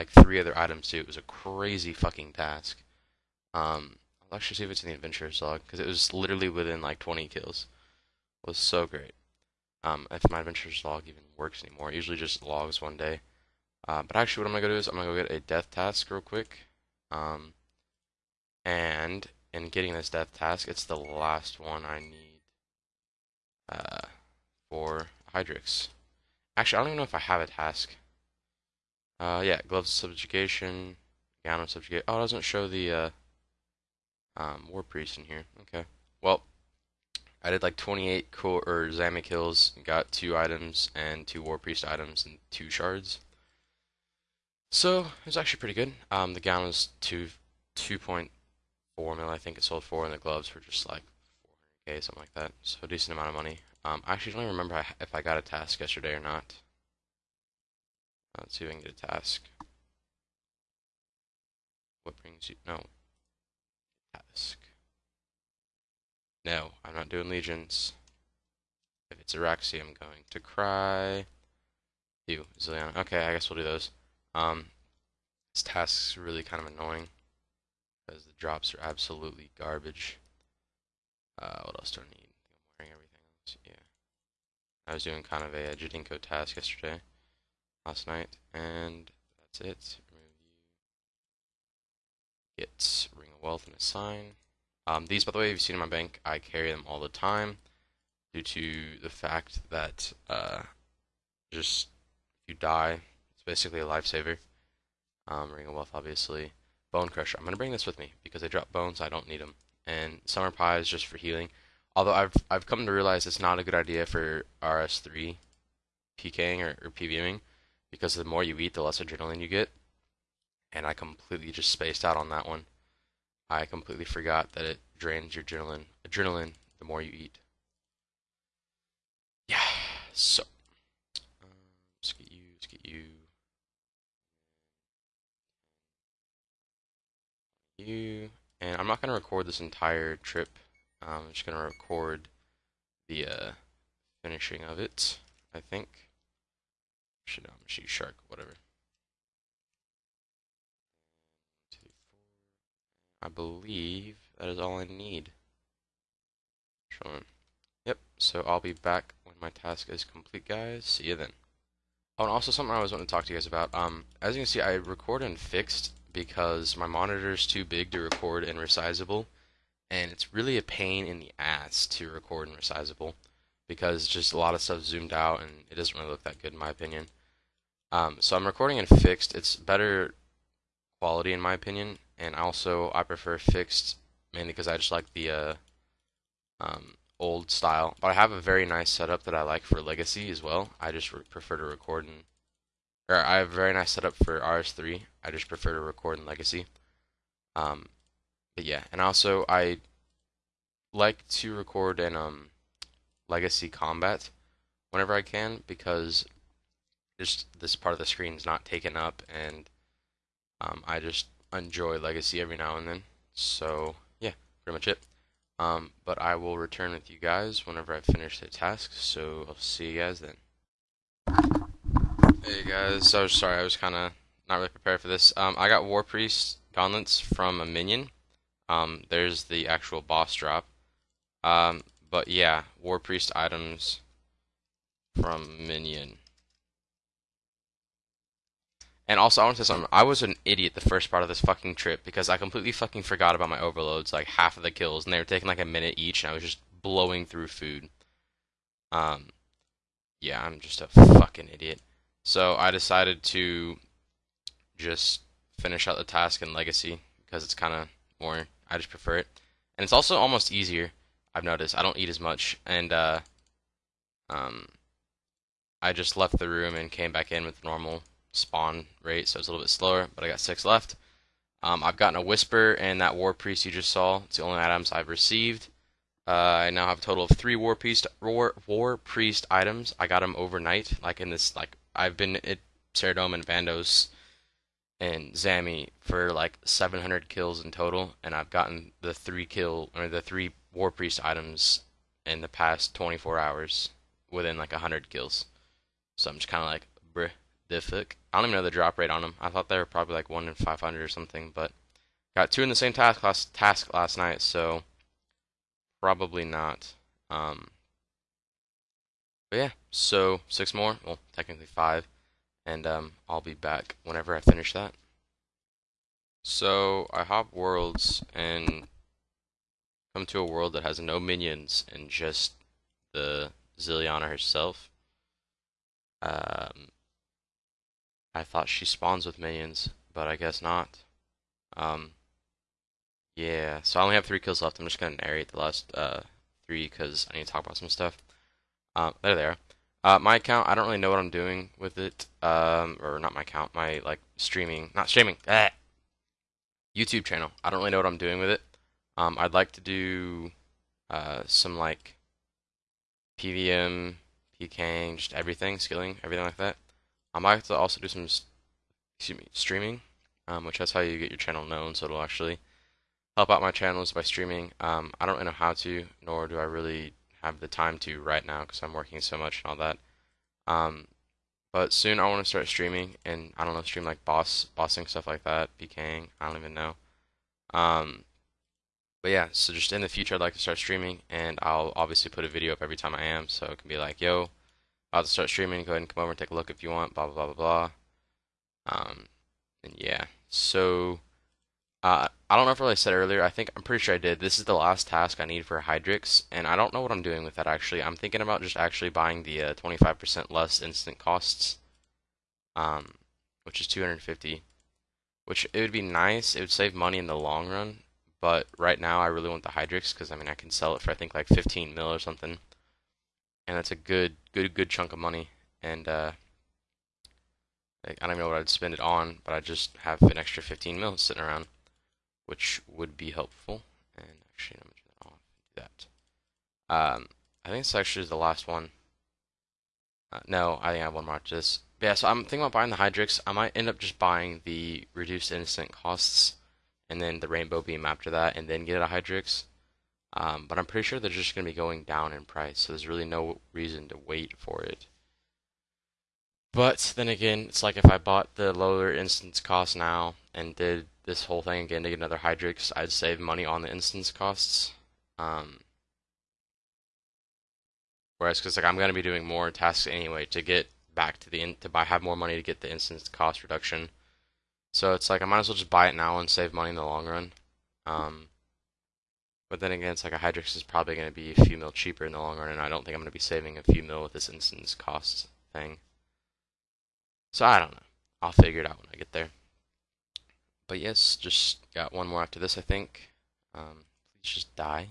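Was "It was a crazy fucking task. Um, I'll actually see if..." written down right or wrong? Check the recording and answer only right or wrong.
right.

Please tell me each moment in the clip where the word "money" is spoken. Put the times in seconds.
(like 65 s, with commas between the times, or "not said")
53 s, 406 s, 415 s, 453 s, 462 s, 466 s.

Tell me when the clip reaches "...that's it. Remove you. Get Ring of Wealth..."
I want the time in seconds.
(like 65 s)
89 s.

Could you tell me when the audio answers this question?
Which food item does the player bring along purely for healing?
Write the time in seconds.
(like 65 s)
110 s.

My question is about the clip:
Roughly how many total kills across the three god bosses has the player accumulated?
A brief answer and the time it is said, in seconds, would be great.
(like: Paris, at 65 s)
700, at 286 s.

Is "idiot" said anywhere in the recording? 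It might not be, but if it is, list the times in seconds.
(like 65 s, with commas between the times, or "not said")
240 s, 251 s.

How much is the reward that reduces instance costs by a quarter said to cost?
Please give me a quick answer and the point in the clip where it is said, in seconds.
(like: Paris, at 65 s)
250, at 403 s.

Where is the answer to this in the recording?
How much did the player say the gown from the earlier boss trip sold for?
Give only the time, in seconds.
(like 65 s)
47 s.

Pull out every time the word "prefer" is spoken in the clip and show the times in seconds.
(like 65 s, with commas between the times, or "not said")
183 s, 191 s, 195 s, 258 s.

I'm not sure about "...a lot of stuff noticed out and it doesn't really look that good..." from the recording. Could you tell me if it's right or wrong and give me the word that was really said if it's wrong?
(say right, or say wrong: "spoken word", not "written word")
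wrong: "zoomed", not "noticed".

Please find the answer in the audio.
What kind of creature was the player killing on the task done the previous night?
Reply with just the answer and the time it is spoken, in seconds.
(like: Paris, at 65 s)
Jadinko, at 85 s.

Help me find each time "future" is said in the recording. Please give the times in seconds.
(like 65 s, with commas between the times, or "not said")
380 s.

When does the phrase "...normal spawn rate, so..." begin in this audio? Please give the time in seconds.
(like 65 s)
267 s.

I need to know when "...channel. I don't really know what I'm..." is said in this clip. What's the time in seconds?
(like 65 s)
347 s.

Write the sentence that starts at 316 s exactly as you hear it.
So I hop worlds and come to a world that has no minions and just the Zilyana herself.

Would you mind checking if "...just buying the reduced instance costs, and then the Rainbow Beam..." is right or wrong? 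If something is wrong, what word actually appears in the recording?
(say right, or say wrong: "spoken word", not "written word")
right.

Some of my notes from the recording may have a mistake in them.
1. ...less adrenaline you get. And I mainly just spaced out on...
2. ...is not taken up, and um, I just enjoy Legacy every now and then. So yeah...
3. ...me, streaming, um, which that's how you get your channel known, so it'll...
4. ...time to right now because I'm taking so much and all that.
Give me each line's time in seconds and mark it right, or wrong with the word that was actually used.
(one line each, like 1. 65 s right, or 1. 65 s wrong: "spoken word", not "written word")
1. 118 s wrong: "completely", not "mainly"
2. 208 s right
3. 359 s right
4. 367 s wrong: "working", not "taking".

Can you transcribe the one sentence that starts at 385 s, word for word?
Go ahead and come over and take a look if you want.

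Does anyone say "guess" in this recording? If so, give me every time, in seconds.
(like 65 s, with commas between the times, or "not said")
73 s, 330 s.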